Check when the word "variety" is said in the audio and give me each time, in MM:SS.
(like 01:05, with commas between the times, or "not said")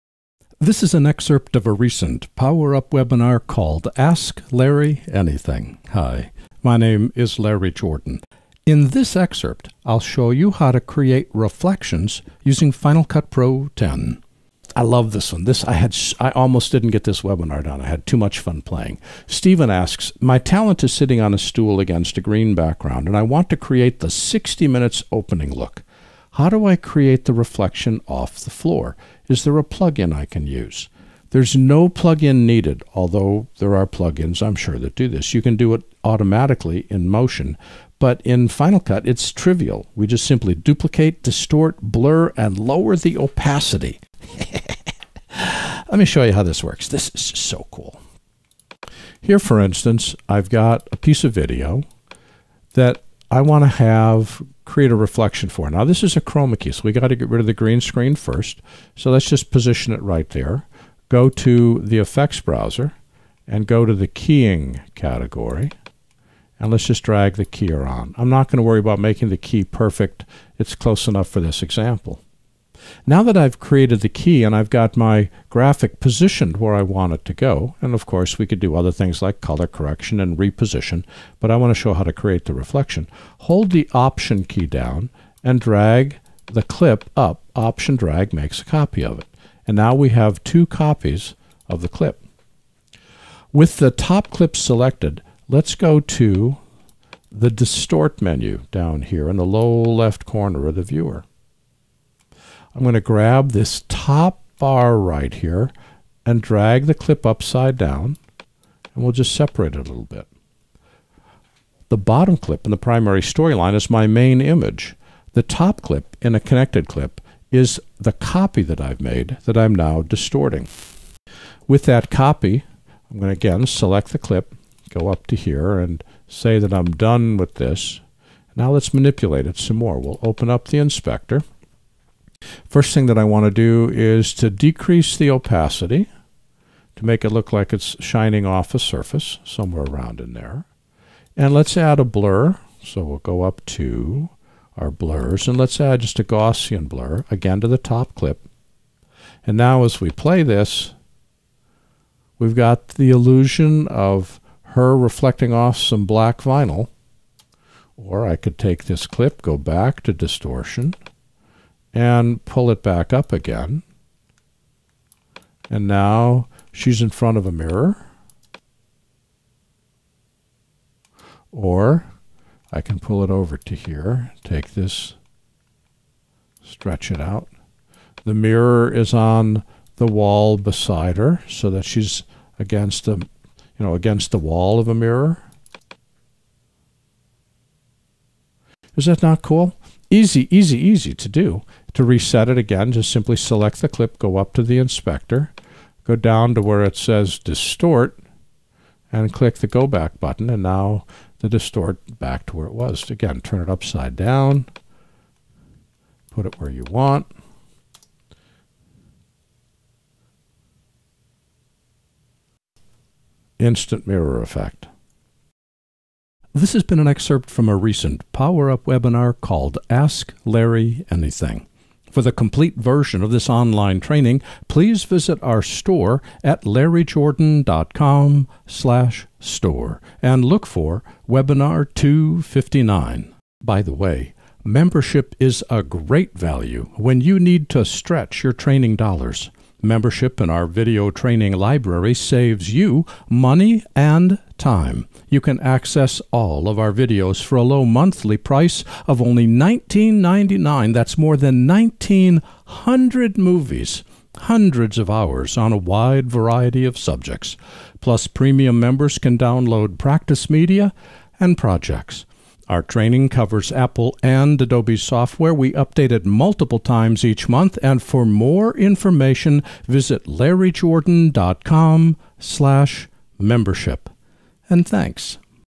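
04:16.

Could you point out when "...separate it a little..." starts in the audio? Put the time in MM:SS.
01:49.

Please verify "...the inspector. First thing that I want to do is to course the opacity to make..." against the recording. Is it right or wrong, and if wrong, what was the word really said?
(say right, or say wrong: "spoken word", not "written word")
wrong: "decrease", not "course".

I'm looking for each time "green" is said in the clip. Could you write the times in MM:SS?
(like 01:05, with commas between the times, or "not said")
00:22, 00:57.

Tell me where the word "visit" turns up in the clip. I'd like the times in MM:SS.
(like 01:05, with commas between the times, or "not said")
03:45, 04:29.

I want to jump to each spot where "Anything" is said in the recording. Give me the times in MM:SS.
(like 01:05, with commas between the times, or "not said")
00:05, 03:41.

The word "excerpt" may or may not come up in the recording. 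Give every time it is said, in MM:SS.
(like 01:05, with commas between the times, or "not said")
00:01, 00:09, 03:37.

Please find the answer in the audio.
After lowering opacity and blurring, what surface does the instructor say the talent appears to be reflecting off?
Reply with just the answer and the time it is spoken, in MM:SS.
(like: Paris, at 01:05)
black vinyl, at 02:36.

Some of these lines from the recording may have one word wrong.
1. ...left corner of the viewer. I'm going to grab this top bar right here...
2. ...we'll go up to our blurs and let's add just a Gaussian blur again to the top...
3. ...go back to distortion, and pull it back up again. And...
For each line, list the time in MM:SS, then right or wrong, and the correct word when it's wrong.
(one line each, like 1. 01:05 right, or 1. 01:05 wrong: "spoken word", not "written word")
1. 01:39 right
2. 02:23 right
3. 02:39 right.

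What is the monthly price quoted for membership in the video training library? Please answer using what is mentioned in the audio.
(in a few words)
$19.99.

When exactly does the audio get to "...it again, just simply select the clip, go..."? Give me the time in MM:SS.
03:12.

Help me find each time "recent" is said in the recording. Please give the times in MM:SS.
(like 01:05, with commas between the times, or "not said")
00:01, 03:37.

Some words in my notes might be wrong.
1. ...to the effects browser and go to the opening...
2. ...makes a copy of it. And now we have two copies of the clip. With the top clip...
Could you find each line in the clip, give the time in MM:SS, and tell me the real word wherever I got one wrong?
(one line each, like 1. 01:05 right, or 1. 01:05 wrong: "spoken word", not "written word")
1. 01:01 wrong: "keying", not "opening"
2. 01:28 right.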